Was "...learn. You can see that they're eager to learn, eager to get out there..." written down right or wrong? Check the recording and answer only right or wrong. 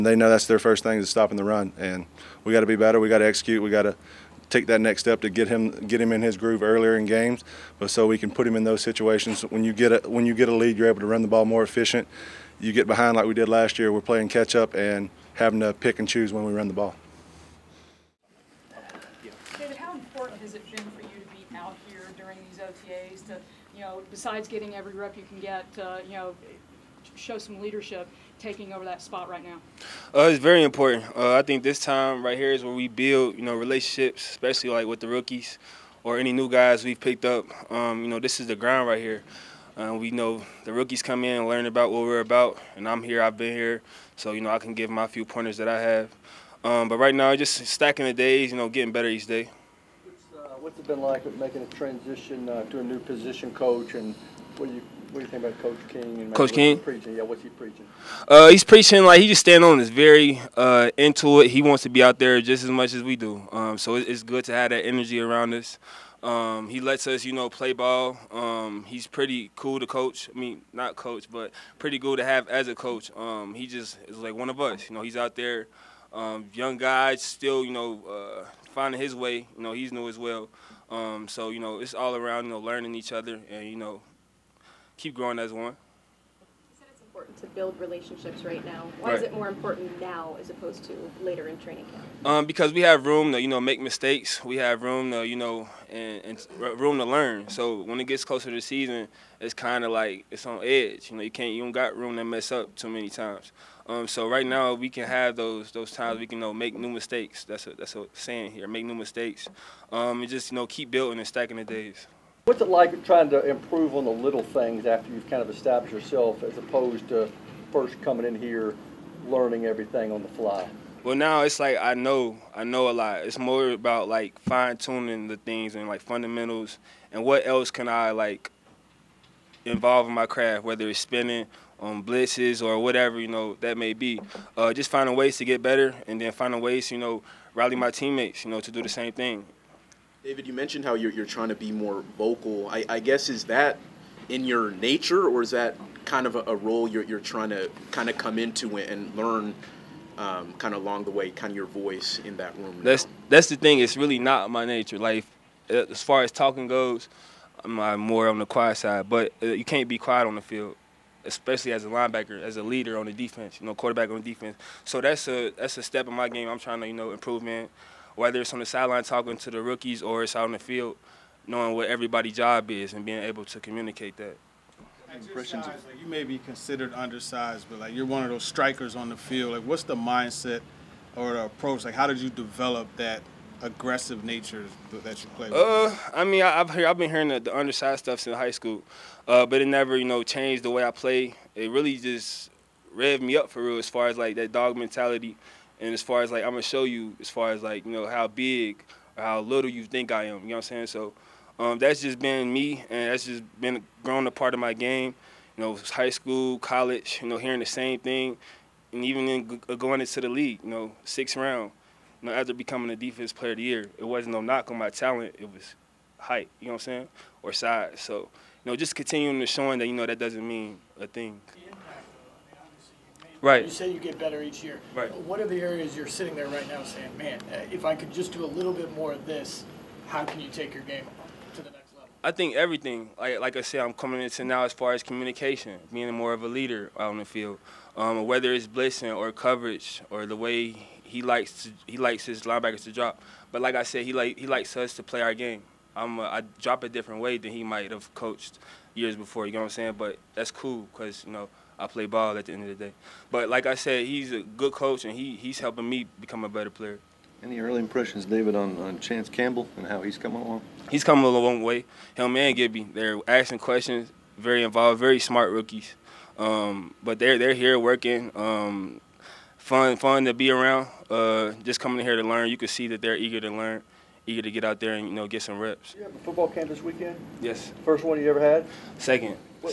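right.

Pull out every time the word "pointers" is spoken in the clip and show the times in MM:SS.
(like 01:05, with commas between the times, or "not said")
00:45.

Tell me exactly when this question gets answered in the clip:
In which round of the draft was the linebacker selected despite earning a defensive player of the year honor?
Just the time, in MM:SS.
03:31.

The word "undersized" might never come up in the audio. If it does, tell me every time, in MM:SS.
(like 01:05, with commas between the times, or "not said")
02:56, 03:07.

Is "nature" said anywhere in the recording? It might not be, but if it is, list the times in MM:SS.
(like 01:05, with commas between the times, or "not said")
02:24, 02:34, 03:04.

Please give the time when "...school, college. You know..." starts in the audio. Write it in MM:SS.
03:26.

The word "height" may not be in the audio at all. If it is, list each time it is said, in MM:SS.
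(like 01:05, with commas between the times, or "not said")
03:36.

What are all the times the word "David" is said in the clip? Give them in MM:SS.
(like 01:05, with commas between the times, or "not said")
00:19, 02:20, 04:18.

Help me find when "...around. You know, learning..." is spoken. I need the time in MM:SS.
01:22.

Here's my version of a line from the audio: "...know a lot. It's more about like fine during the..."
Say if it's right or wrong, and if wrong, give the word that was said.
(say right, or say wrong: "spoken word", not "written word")
wrong: "tuning", not "during".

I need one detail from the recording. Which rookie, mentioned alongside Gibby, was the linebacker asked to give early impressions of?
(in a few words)
Chance Campbell.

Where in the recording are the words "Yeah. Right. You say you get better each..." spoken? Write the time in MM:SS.
03:41.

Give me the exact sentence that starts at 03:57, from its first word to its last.
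Um, whether it's blitzing or coverage or the way he likes to, he likes his linebackers to drop.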